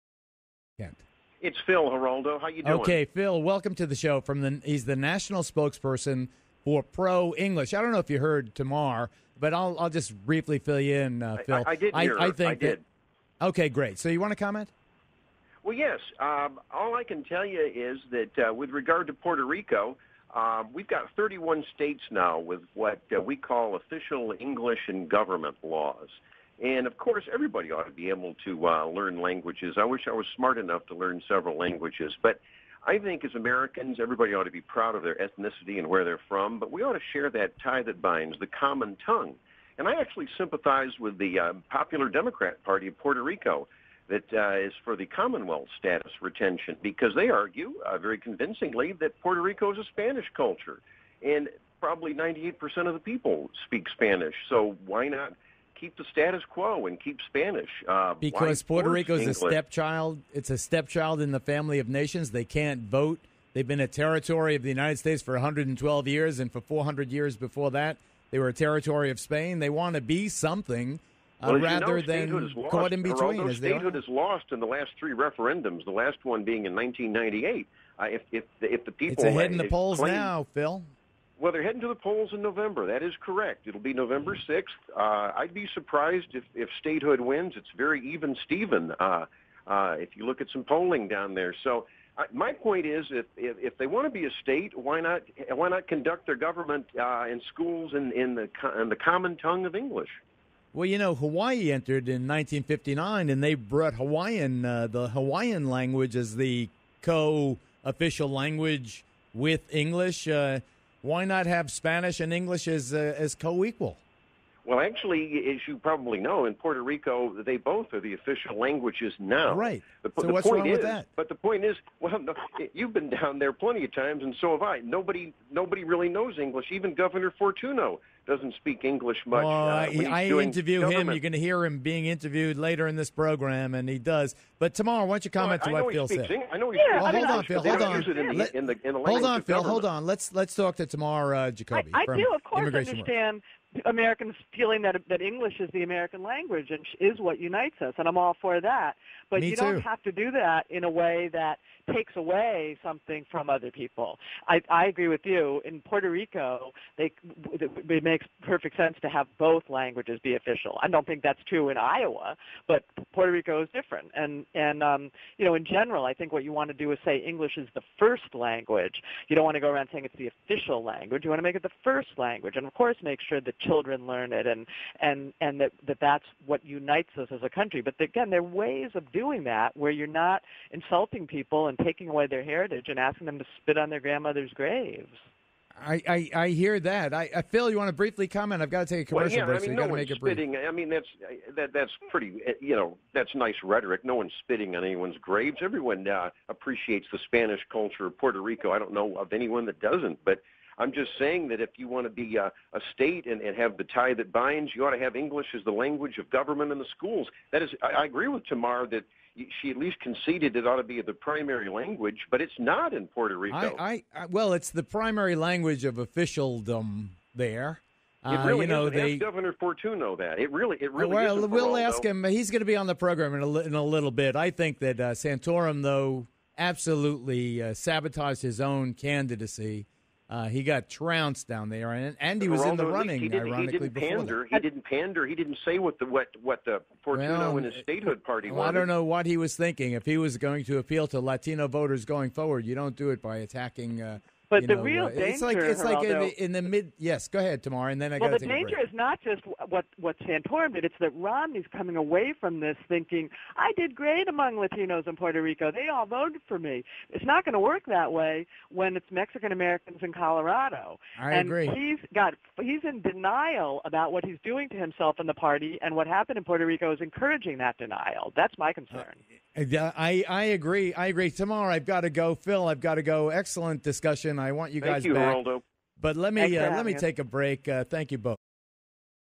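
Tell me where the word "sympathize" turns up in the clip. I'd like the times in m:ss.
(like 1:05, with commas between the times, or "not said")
0:40.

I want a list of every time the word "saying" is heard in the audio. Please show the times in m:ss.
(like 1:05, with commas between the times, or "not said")
2:49, 3:21.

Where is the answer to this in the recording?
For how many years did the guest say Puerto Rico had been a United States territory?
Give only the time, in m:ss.
1:05.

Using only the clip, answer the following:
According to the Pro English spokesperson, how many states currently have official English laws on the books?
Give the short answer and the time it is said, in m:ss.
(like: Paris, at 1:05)
31, at 0:21.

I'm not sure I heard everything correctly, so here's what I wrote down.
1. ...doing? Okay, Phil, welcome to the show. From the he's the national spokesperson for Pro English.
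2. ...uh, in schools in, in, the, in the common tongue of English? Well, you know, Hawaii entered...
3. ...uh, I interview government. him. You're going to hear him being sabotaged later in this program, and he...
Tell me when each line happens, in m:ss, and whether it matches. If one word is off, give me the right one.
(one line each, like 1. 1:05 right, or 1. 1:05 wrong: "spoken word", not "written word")
1. 0:02 right
2. 1:36 right
3. 2:09 wrong: "interviewed", not "sabotaged".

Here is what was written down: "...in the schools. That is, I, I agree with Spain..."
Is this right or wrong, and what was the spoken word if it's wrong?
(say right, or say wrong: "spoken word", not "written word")
wrong: "Tamar", not "Spain".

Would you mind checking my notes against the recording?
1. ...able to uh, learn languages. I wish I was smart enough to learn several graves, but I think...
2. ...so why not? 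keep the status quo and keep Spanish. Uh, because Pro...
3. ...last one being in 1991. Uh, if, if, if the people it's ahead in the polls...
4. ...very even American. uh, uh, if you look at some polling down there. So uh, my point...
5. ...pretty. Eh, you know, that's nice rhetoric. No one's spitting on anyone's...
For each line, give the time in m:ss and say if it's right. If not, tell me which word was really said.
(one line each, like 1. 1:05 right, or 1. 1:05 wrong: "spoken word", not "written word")
1. 0:28 wrong: "languages", not "graves"
2. 0:54 wrong: "Puerto", not "Pro"
3. 1:15 wrong: "1998", not "1991"
4. 1:27 wrong: "Stephen", not "American"
5. 3:12 right.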